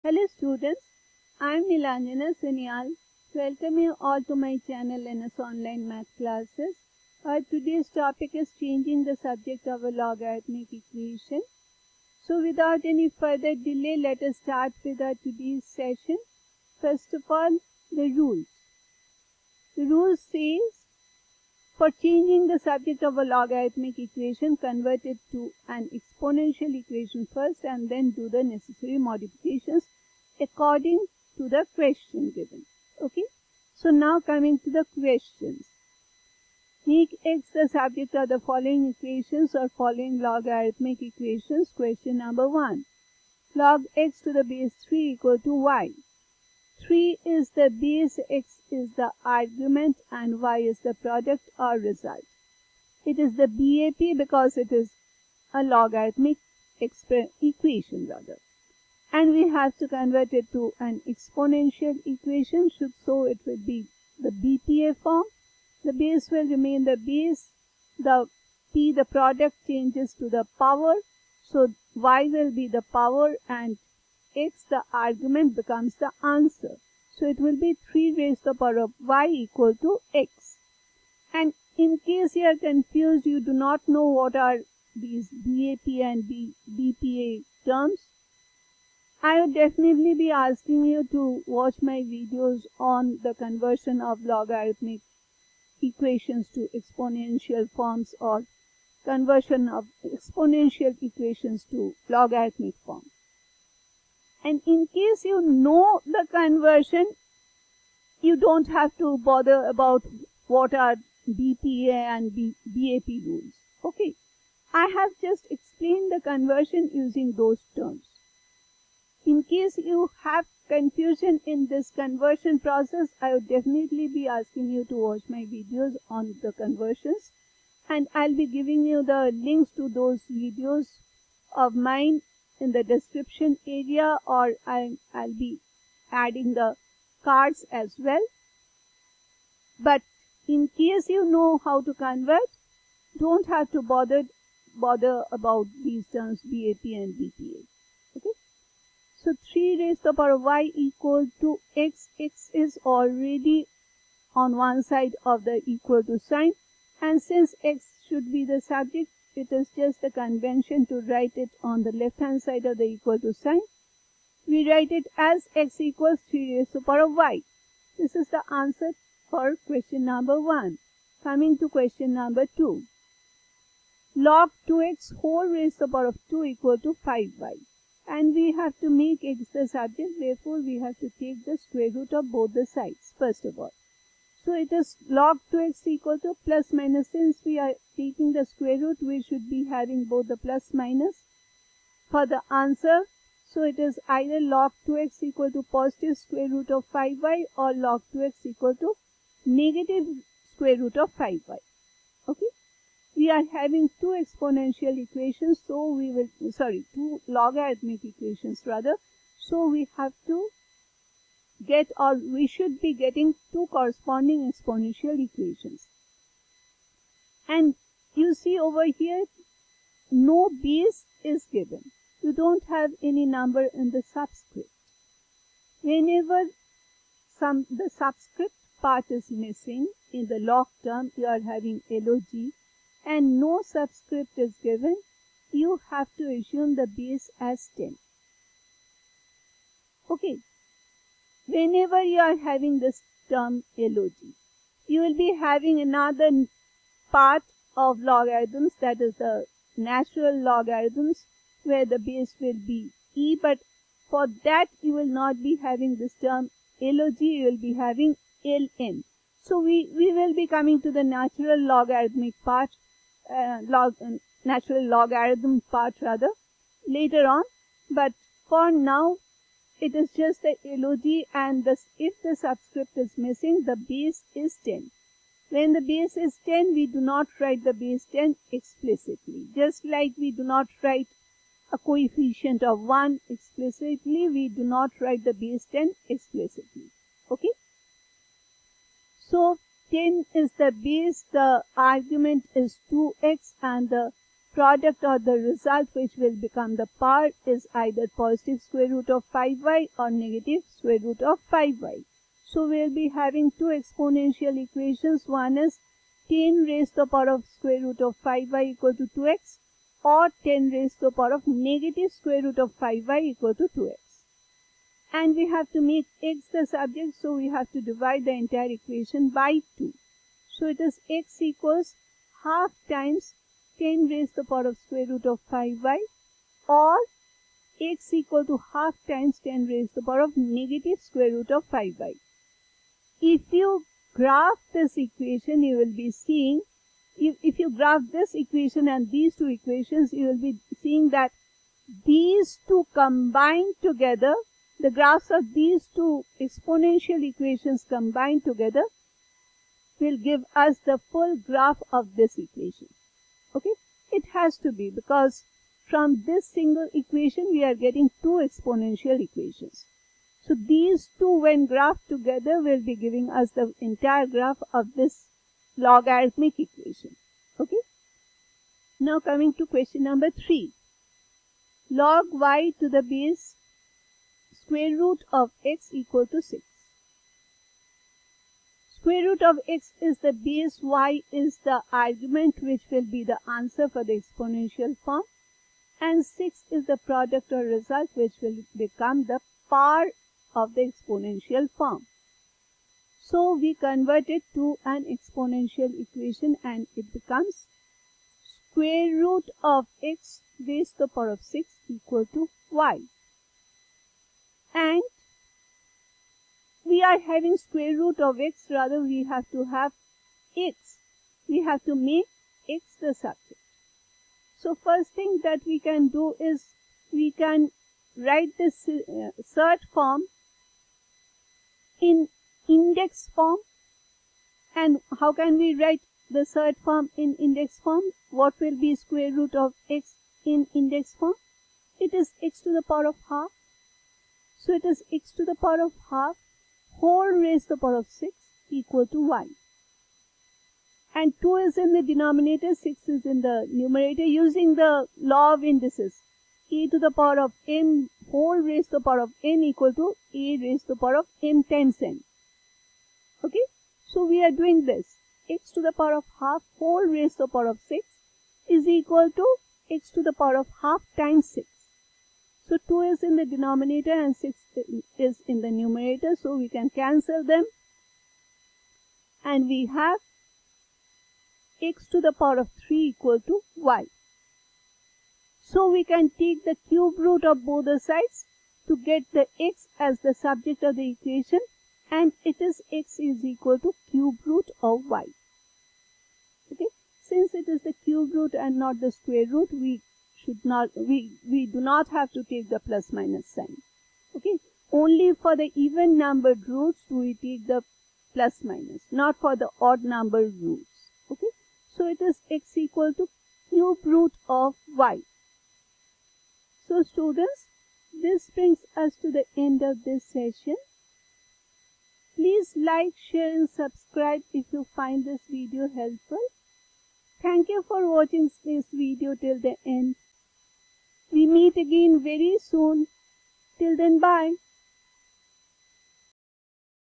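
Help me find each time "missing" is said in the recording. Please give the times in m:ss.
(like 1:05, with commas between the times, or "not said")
3:49, 4:33.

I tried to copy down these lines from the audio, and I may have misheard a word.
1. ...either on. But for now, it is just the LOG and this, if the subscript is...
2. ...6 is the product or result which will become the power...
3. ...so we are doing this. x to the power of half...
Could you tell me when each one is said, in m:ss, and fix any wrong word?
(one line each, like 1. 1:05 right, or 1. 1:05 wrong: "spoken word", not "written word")
1. 4:26 wrong: "later", not "either"
2. 6:26 right
3. 7:34 right.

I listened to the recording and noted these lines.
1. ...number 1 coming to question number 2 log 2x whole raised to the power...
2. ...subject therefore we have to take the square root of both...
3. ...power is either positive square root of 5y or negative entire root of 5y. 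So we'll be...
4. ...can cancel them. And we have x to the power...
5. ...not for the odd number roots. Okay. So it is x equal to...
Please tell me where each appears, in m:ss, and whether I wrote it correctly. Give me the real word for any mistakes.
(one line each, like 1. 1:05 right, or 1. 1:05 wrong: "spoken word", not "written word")
1. 2:50 right
2. 2:59 right
3. 4:56 wrong: "square", not "entire"
4. 7:46 right
5. 8:19 right.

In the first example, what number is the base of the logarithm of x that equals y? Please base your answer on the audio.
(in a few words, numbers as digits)
3.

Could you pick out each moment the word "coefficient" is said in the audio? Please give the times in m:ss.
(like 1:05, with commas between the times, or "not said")
4:41.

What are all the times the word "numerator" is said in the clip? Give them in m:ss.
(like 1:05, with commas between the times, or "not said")
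7:23, 7:45.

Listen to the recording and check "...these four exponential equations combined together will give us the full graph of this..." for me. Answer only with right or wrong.
wrong.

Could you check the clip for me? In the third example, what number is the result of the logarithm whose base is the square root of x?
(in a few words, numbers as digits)
6.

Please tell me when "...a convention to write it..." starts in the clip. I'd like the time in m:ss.
2:40.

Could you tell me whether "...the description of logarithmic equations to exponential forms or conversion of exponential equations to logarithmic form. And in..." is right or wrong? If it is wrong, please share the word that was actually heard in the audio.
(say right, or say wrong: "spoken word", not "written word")
wrong: "conversion", not "description".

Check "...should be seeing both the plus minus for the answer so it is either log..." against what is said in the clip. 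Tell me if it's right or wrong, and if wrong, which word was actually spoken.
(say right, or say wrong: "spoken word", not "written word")
wrong: "having", not "seeing".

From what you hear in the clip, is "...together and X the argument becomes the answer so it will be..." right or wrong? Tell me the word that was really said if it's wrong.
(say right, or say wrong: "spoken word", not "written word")
wrong: "power", not "together".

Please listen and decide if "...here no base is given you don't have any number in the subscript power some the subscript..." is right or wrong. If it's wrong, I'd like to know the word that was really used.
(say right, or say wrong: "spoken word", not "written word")
wrong: "whenever", not "power".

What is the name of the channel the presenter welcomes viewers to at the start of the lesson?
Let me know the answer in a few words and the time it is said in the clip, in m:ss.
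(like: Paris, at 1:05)
NS Online Math Classes, at 0:05.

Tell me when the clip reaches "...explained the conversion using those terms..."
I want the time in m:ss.
1:55.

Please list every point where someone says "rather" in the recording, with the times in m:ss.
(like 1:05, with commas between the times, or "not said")
0:58, 3:28, 4:26, 6:48.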